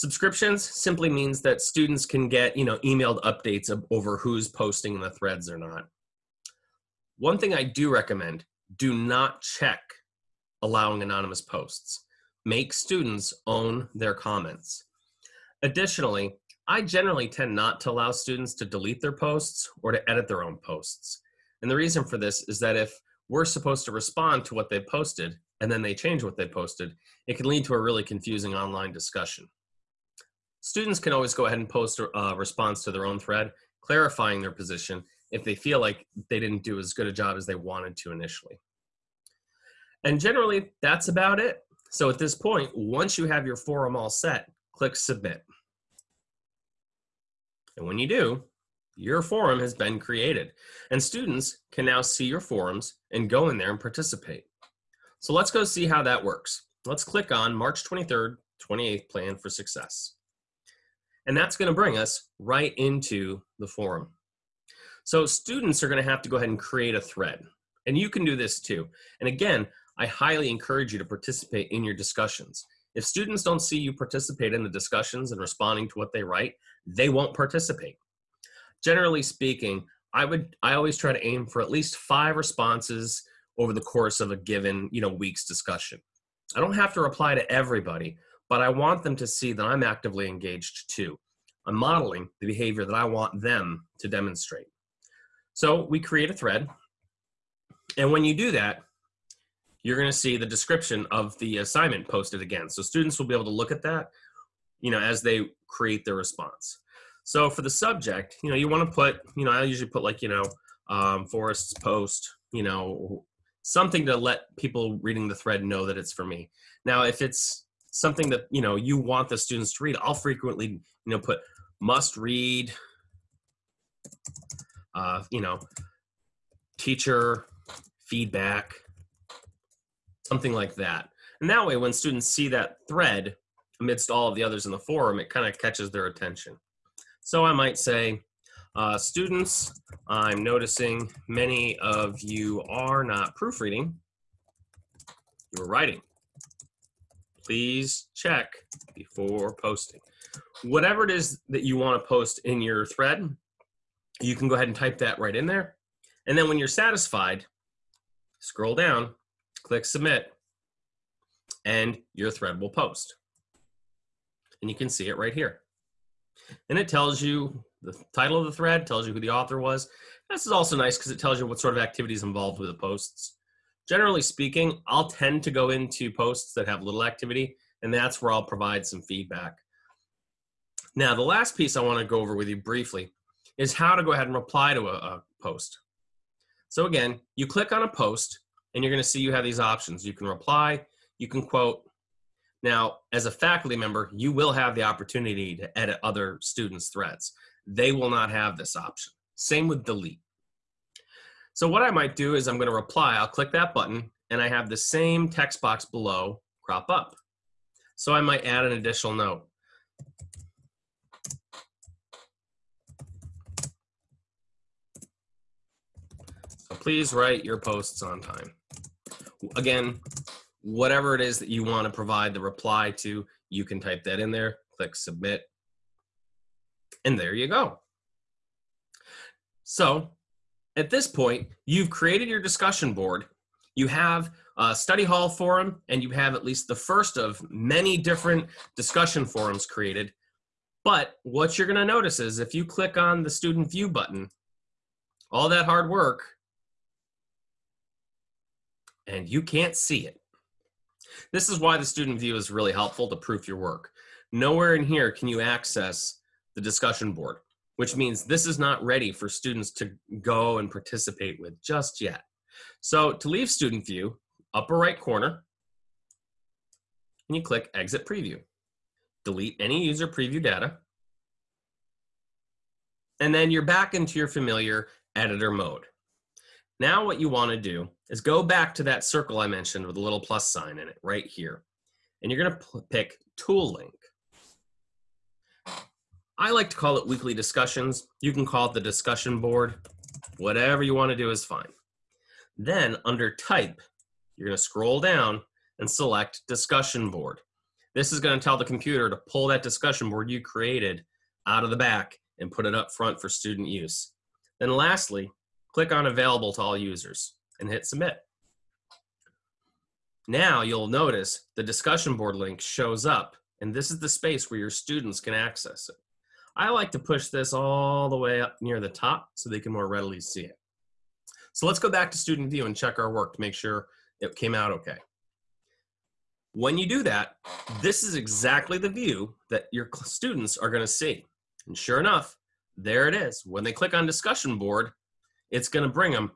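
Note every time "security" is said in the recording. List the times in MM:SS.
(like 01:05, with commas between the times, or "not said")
not said.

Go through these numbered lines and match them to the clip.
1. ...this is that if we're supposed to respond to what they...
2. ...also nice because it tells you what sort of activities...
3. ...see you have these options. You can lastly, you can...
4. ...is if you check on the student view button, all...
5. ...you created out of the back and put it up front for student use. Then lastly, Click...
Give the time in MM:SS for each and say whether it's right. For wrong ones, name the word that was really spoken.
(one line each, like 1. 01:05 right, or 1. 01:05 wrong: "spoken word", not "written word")
1. 00:22 right
2. 02:50 right
3. 03:09 wrong: "reply", not "lastly"
4. 04:02 wrong: "click", not "check"
5. 05:00 right.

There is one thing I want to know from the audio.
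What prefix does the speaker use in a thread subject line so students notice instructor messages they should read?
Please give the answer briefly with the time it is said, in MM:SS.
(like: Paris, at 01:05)
Must read, at 02:01.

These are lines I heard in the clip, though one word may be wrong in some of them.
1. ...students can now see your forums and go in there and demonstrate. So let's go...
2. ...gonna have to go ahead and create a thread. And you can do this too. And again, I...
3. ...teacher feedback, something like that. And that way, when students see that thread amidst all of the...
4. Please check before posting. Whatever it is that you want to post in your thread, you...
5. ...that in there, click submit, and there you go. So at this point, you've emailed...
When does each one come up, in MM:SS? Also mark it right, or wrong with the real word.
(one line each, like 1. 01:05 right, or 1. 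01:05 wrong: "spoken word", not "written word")
1. 00:51 wrong: "participate", not "demonstrate"
2. 01:05 right
3. 02:06 right
4. 02:27 right
5. 03:44 wrong: "created", not "emailed".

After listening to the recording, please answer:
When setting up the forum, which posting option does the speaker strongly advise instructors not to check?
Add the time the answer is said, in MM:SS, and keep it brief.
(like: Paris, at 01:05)
Allowing anonymous posts, at 00:10.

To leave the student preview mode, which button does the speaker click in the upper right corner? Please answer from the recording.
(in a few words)
Exit preview.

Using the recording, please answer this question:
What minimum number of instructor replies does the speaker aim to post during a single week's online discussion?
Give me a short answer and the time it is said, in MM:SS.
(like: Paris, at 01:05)
5, at 01:21.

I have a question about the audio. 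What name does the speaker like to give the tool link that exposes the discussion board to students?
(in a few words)
Weekly discussions.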